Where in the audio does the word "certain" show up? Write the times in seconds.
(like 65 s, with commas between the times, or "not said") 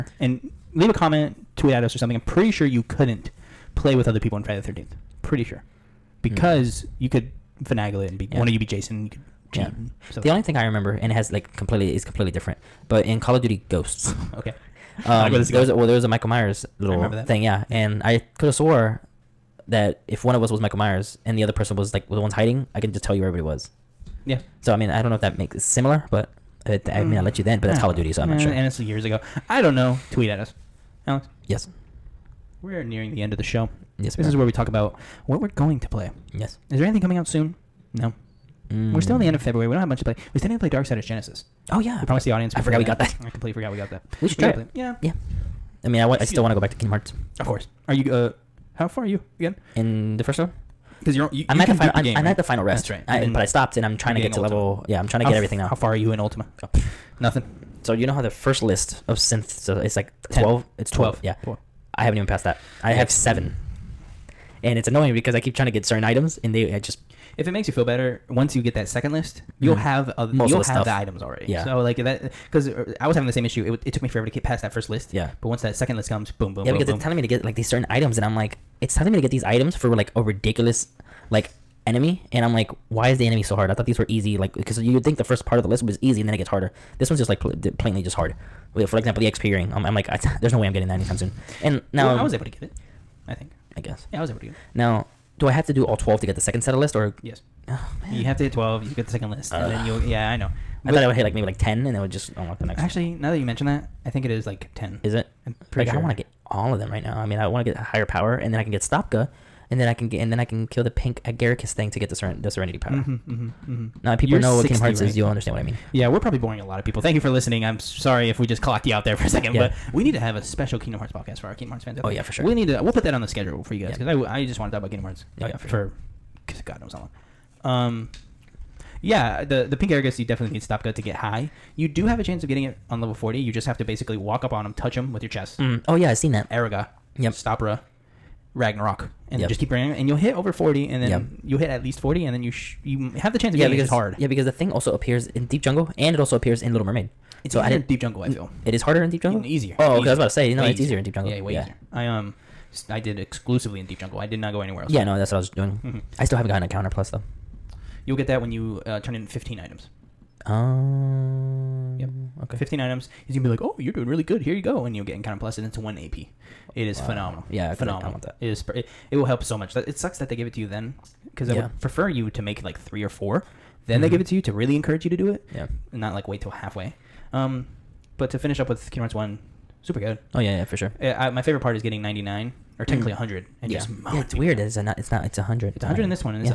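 65 s, 77 s.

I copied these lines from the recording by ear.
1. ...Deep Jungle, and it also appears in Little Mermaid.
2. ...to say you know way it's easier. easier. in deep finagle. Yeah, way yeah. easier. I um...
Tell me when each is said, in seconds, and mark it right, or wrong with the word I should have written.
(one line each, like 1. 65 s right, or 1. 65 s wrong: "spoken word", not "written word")
1. 145 s right
2. 150 s wrong: "jungle", not "finagle".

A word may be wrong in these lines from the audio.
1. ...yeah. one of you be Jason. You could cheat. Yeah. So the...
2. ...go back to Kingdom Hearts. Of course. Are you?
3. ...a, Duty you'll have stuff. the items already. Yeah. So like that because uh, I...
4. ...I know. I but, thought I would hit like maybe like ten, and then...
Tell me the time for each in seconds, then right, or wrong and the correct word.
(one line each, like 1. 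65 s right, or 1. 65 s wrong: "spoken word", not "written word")
1. 8 s right
2. 46 s right
3. 70 s wrong: "Most", not "Duty"
4. 100 s right.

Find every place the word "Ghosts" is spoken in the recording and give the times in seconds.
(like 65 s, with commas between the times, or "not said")
13 s.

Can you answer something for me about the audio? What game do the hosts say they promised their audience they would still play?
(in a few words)
Darksiders Genesis.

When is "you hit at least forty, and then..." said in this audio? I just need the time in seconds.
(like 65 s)
141 s.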